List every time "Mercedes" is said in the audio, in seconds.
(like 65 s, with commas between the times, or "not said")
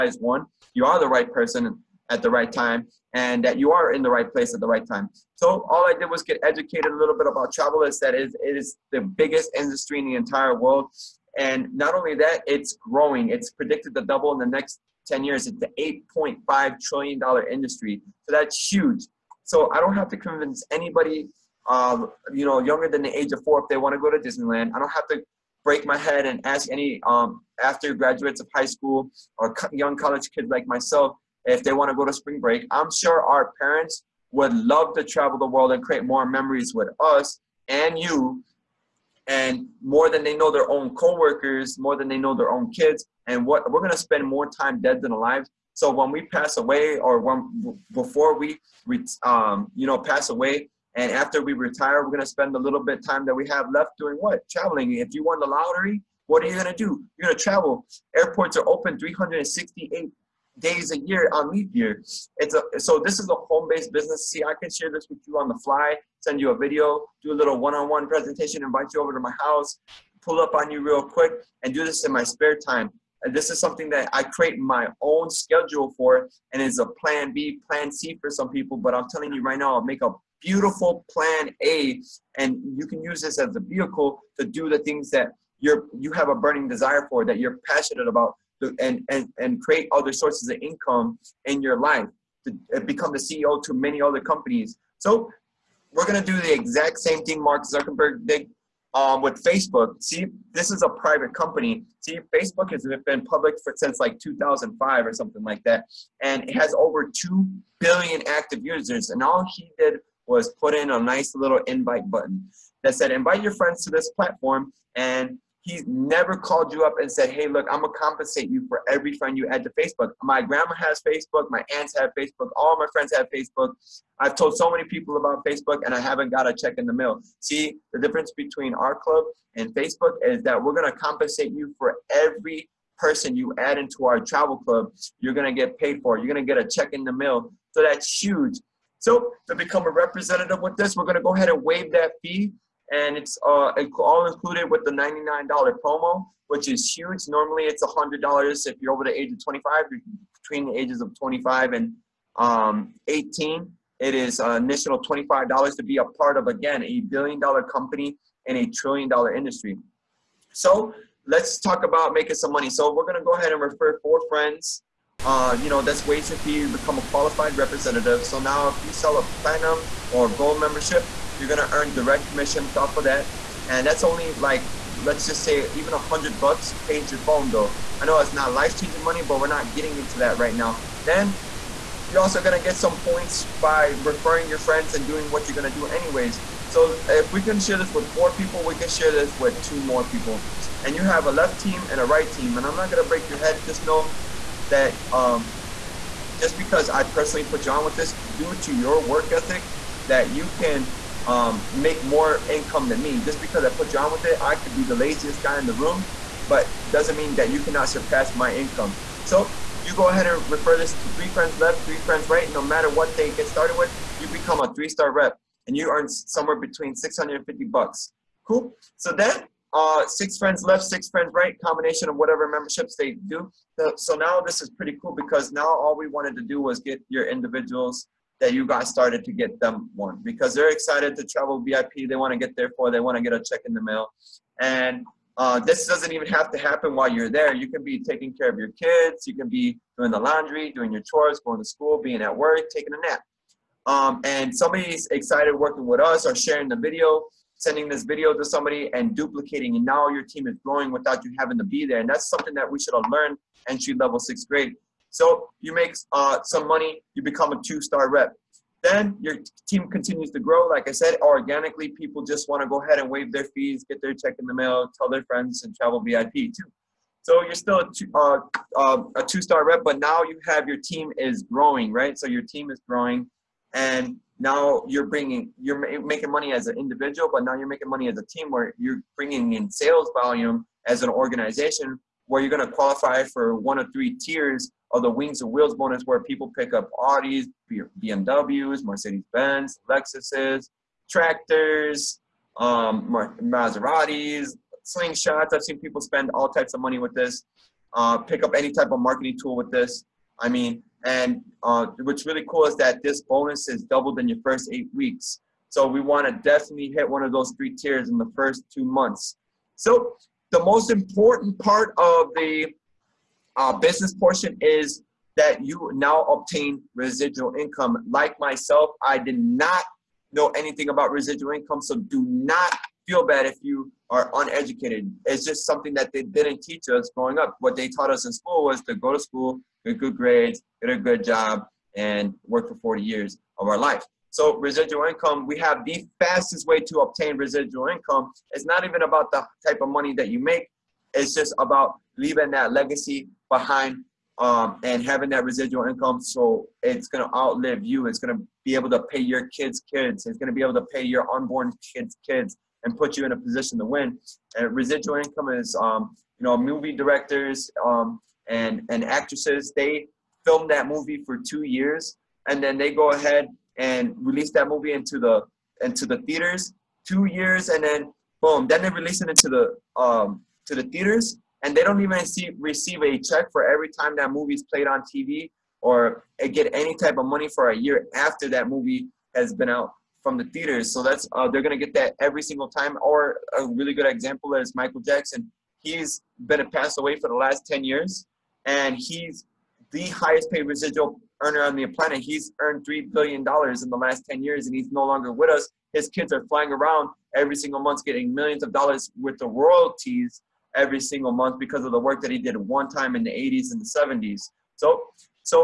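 288 s.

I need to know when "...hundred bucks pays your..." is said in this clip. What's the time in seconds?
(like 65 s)
175 s.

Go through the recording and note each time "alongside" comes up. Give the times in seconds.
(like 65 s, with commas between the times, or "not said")
not said.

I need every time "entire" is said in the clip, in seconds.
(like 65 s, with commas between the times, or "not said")
10 s.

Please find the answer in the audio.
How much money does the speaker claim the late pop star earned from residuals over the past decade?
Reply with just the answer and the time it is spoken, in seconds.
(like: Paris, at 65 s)
3 billion dollars, at 392 s.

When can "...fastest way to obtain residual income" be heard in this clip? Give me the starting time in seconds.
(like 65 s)
336 s.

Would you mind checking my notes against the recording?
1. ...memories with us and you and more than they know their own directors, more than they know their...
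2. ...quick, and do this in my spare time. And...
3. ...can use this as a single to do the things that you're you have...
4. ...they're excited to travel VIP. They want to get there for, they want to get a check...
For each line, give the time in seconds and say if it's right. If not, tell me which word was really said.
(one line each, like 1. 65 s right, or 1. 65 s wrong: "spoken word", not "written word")
1. 36 s wrong: "coworkers", not "directors"
2. 71 s right
3. 82 s wrong: "vehicle", not "single"
4. 230 s right.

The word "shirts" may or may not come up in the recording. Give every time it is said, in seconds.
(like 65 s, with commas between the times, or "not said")
not said.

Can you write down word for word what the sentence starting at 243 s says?
Um, and somebody's excited working with us or sharing the video, sending this video to somebody and duplicating.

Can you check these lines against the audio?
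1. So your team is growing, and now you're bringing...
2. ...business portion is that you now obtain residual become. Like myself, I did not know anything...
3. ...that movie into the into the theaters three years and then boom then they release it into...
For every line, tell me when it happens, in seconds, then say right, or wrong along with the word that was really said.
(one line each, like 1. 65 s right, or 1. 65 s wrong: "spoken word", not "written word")
1. 272 s right
2. 313 s wrong: "income", not "become"
3. 364 s wrong: "two", not "three".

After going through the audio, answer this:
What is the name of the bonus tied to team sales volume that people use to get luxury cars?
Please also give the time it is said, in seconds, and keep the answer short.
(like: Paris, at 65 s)
Wings and Wheels bonus, at 285 s.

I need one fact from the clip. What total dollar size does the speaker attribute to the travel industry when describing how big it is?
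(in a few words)
$8.5 trillion.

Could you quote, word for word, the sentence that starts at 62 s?
It's a, so this is a home-based business.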